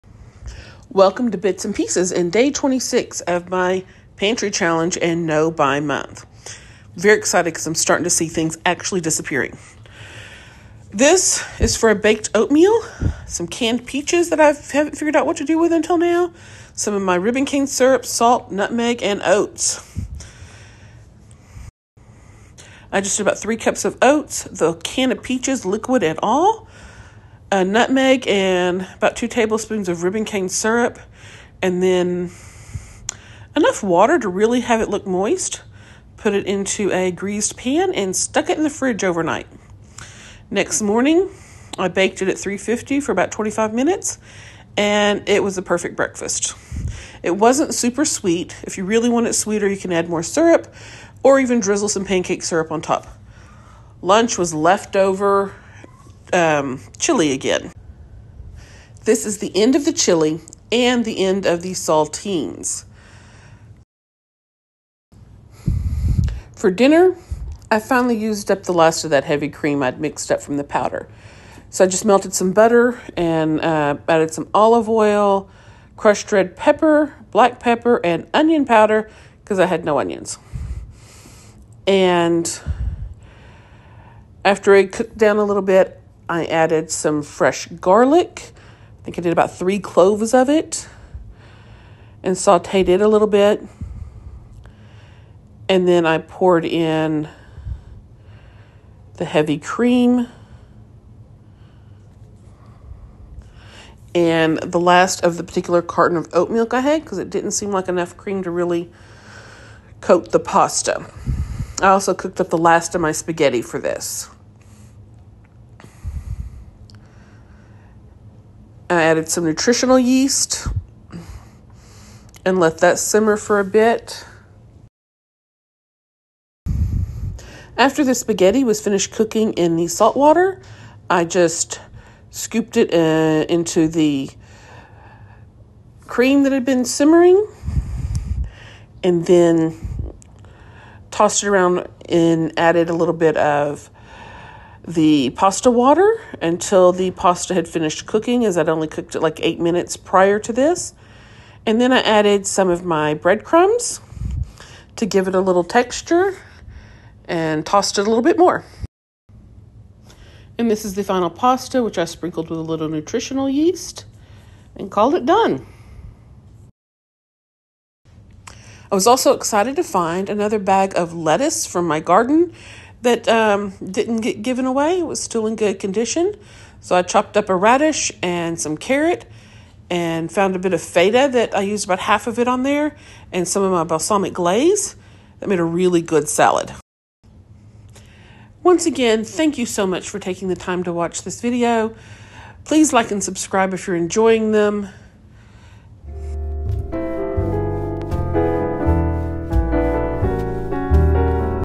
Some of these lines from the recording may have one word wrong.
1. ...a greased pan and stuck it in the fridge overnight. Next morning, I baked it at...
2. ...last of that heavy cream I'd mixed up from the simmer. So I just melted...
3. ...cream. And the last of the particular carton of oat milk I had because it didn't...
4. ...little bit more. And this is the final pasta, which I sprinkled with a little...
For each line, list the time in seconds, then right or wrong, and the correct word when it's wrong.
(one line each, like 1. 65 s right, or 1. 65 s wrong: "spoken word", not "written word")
1. 36 s right
2. 68 s wrong: "powder", not "simmer"
3. 99 s right
4. 158 s right.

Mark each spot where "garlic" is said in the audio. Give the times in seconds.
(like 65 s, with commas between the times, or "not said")
87 s.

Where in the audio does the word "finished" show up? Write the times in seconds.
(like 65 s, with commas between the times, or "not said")
128 s, 147 s.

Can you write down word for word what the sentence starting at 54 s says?
Lunch was leftover um, chili again.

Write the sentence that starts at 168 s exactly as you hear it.
I was also excited to find another bag of lettuce from my garden that um, didn't get given away.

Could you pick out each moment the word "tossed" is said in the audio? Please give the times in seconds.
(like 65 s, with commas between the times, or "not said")
141 s, 157 s.